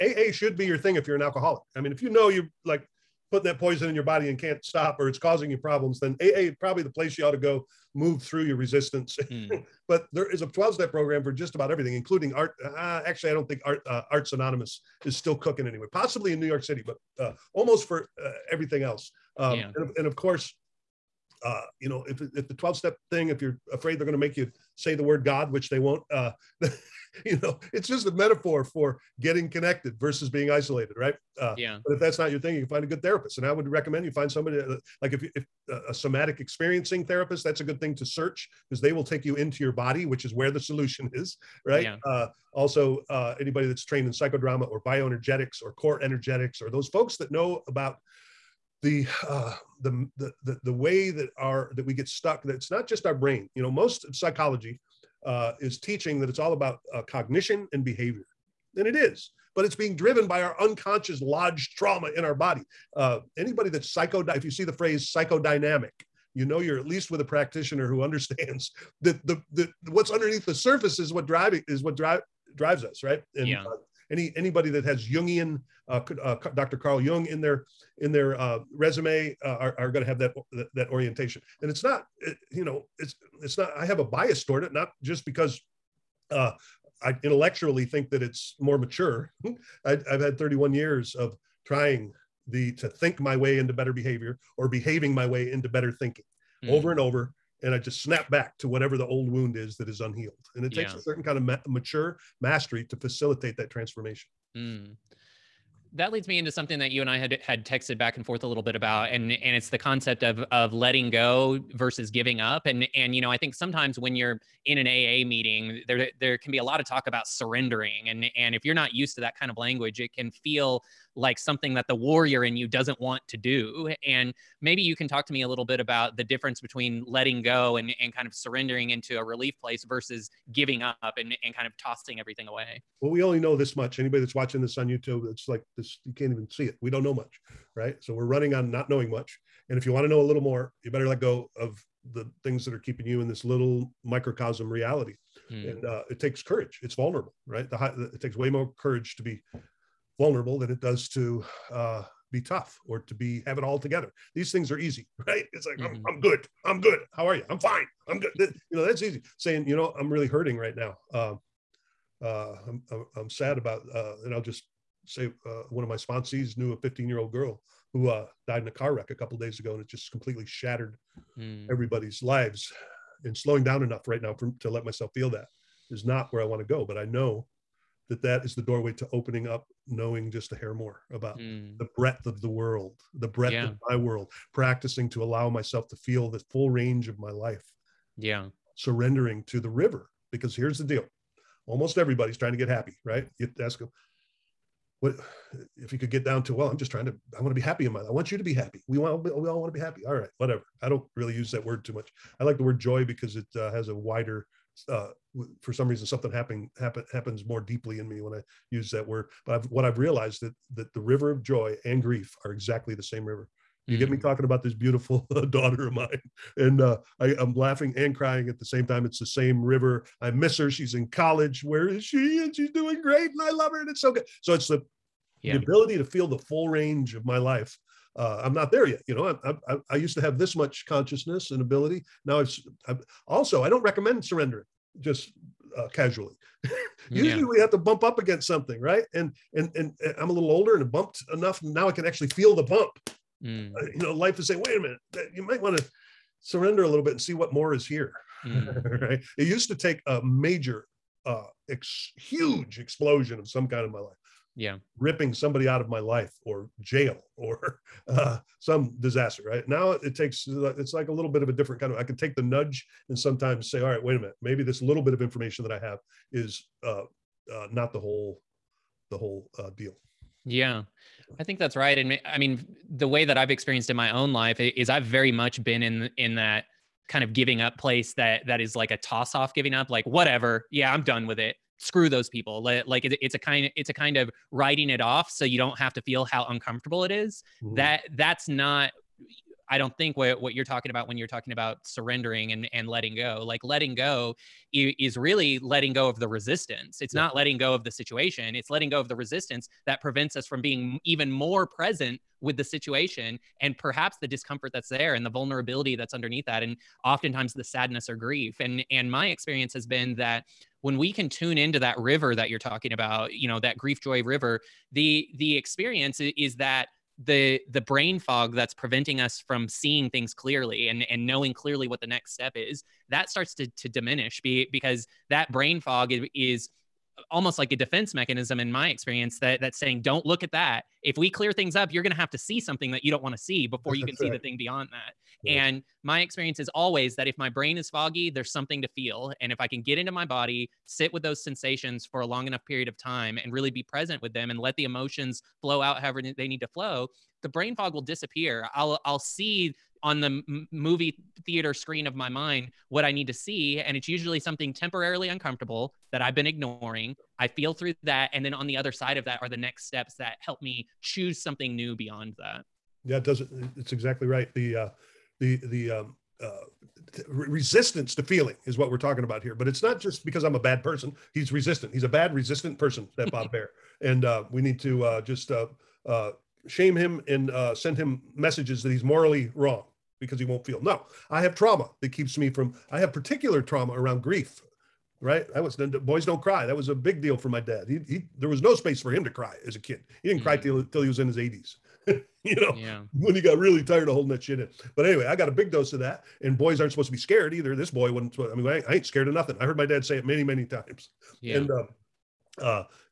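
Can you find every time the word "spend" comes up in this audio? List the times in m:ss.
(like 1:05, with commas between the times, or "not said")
not said.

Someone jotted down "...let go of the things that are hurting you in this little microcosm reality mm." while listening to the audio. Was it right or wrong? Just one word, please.
wrong.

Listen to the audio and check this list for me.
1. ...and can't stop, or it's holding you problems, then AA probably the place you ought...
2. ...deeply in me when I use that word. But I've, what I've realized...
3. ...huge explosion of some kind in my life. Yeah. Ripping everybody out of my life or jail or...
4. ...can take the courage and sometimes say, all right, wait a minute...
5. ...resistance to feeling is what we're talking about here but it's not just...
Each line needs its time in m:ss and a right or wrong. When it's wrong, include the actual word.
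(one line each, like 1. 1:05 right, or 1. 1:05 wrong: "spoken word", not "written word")
1. 0:04 wrong: "causing", not "holding"
2. 3:27 right
3. 4:12 wrong: "somebody", not "everybody"
4. 4:22 wrong: "nudge", not "courage"
5. 6:07 right.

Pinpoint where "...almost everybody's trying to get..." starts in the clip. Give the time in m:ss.
3:11.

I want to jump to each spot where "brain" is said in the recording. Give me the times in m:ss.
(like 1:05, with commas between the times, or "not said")
0:53, 5:17, 5:25, 5:37, 5:47.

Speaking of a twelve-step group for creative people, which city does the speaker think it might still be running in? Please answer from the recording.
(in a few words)
New York City.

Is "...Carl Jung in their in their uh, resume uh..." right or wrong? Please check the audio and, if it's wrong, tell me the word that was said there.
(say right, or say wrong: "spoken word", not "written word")
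right.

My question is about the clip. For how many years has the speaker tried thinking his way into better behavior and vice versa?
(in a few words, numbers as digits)
31.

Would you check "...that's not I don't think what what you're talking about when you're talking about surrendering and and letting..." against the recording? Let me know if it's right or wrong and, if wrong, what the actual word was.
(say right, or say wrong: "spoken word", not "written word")
right.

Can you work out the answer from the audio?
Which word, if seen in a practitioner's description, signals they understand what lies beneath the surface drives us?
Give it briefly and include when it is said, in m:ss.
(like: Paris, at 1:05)
Psychodynamic, at 1:05.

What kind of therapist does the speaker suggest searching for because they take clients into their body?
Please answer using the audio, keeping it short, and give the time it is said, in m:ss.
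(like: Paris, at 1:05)
Somatic experiencing therapist, at 0:35.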